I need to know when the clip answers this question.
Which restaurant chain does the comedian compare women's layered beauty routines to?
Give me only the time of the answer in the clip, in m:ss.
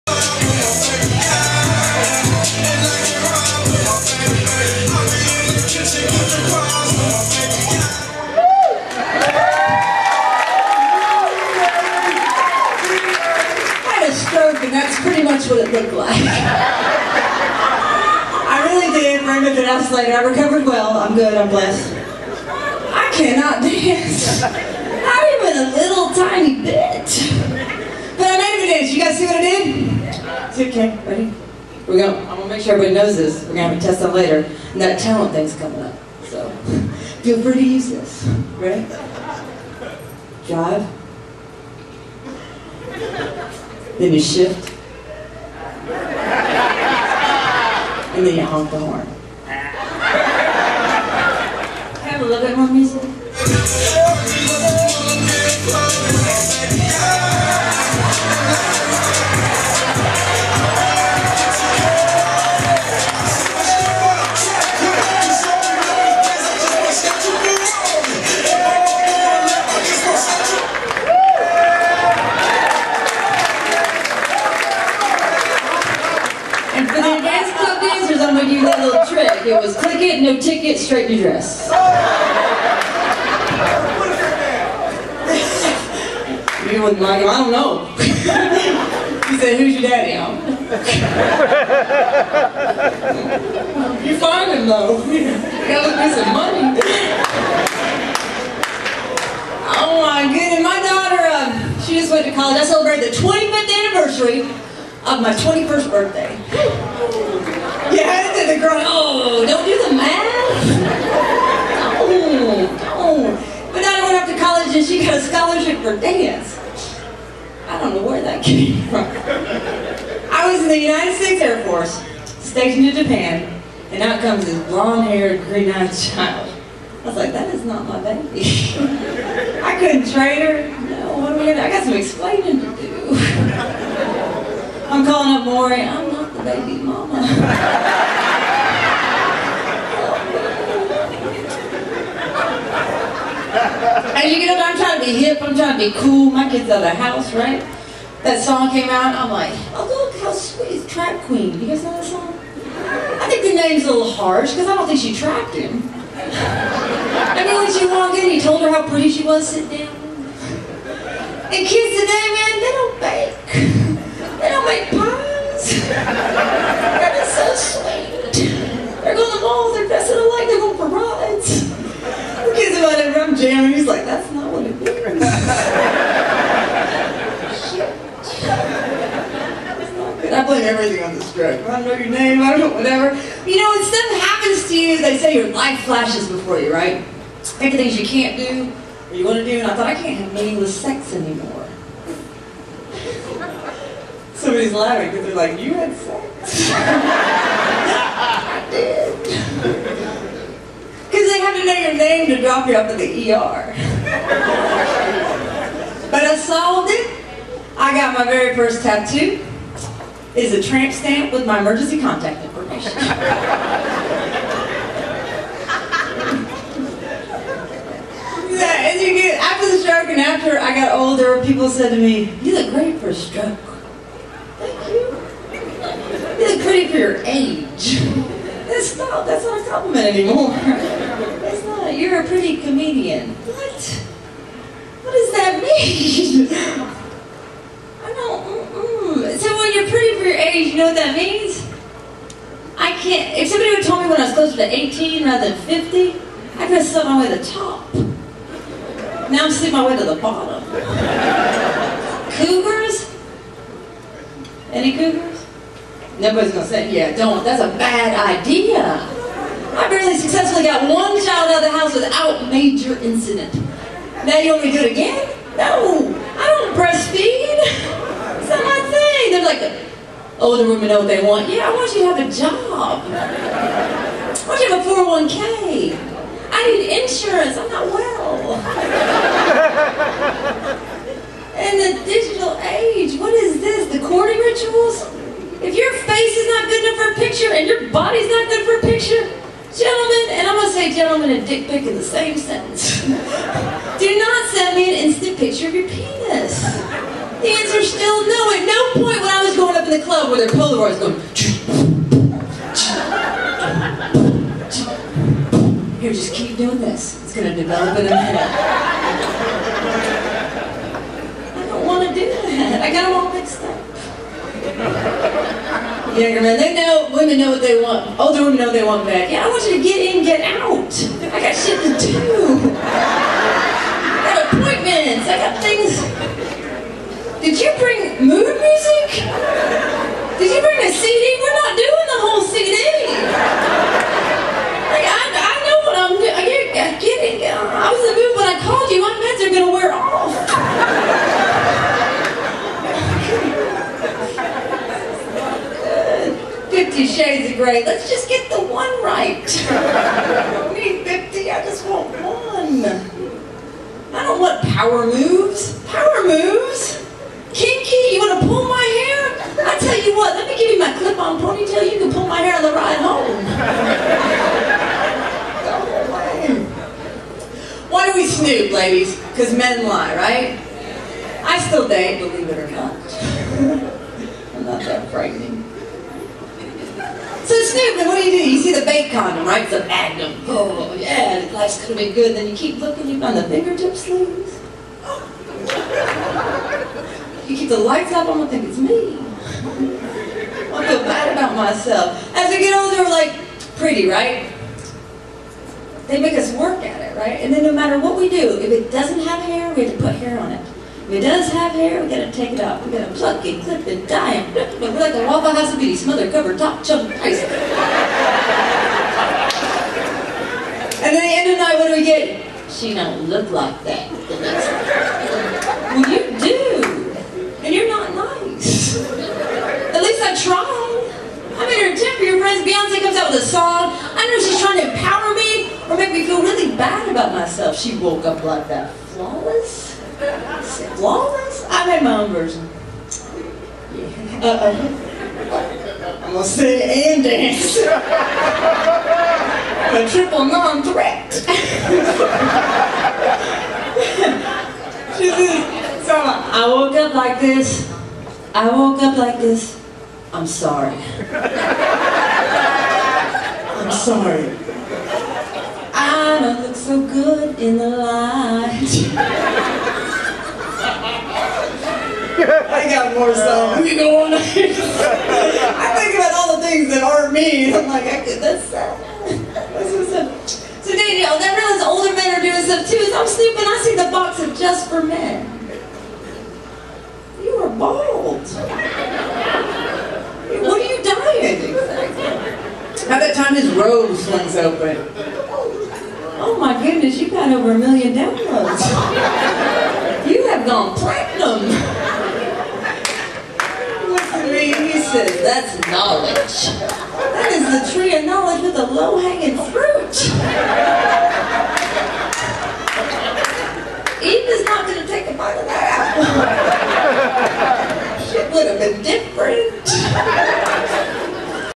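6:45.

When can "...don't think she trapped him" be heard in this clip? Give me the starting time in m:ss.
2:34.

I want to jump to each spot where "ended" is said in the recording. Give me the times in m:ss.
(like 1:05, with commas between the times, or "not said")
not said.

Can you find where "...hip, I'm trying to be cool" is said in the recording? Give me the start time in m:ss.
2:25.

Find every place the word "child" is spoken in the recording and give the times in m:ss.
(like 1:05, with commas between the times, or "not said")
2:05, 4:21.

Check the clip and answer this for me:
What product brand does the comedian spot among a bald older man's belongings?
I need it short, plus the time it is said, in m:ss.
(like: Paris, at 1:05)
Just for Men, at 7:54.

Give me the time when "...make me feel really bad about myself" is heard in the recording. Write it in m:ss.
7:05.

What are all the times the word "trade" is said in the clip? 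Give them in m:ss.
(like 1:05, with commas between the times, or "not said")
2:10.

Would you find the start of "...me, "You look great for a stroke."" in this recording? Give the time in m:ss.
3:41.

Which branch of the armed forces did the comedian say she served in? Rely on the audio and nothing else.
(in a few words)
United States Air Force.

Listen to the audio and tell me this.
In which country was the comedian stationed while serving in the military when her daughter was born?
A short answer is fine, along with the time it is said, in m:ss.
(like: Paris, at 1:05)
Japan, at 2:02.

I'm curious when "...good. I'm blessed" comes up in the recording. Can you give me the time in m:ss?
0:21.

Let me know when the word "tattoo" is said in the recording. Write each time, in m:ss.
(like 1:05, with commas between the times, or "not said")
3:28.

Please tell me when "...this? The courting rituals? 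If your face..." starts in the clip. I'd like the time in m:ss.
4:43.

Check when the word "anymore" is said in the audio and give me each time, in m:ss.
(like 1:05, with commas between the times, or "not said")
3:11, 3:50.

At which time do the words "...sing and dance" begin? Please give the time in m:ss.
7:16.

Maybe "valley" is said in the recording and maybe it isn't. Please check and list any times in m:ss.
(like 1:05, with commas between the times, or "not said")
not said.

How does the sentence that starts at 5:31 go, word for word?
We're not doing the whole CD.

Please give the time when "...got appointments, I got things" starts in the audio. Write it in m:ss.
5:24.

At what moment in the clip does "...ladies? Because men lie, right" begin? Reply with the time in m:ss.
6:08.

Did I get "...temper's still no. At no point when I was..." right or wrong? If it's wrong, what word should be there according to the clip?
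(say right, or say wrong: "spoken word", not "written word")
wrong: "answer", not "temper".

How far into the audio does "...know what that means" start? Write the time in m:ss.
4:00.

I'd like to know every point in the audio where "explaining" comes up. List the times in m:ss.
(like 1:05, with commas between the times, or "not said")
2:11.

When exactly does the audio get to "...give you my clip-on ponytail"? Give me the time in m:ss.
6:00.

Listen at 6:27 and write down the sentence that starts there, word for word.
you keep the lights up, I'm gonna think it's me.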